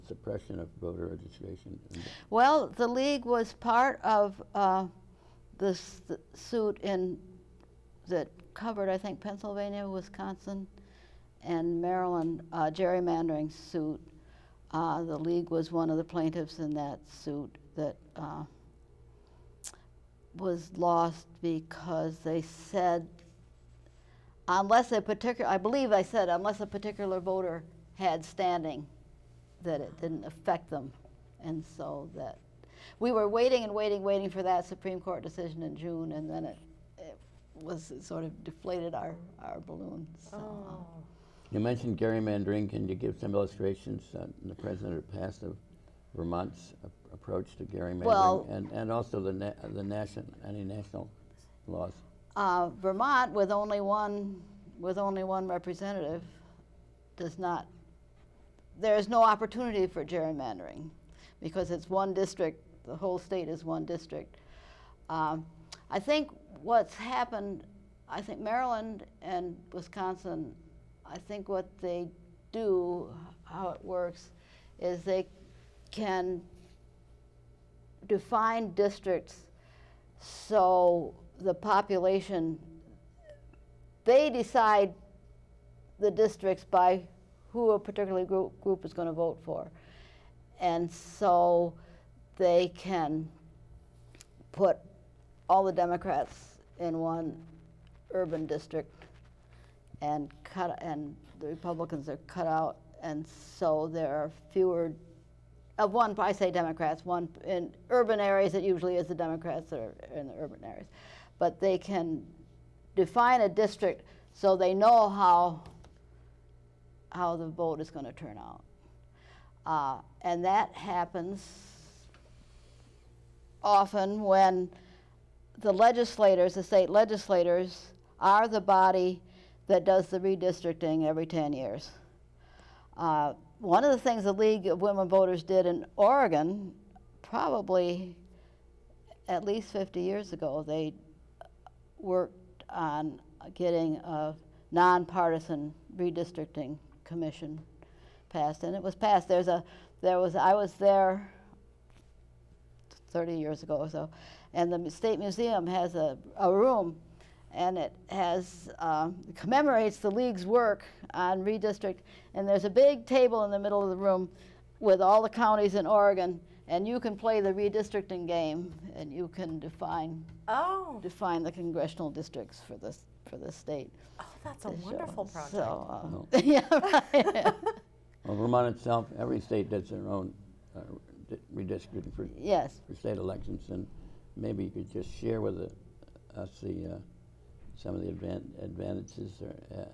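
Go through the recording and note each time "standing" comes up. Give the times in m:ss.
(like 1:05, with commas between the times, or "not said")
0:28.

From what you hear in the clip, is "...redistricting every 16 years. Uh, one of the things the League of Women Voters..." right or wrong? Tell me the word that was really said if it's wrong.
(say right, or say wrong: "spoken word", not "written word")
wrong: "10", not "16".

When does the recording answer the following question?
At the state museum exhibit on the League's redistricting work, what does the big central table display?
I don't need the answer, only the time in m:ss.
2:45.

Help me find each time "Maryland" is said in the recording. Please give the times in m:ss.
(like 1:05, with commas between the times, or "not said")
0:11, 1:08.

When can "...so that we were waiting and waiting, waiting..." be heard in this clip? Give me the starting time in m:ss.
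0:31.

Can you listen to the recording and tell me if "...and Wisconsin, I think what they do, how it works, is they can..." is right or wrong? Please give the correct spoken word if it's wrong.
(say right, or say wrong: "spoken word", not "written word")
right.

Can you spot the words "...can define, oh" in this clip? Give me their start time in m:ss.
2:49.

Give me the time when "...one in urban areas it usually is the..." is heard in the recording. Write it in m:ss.
1:47.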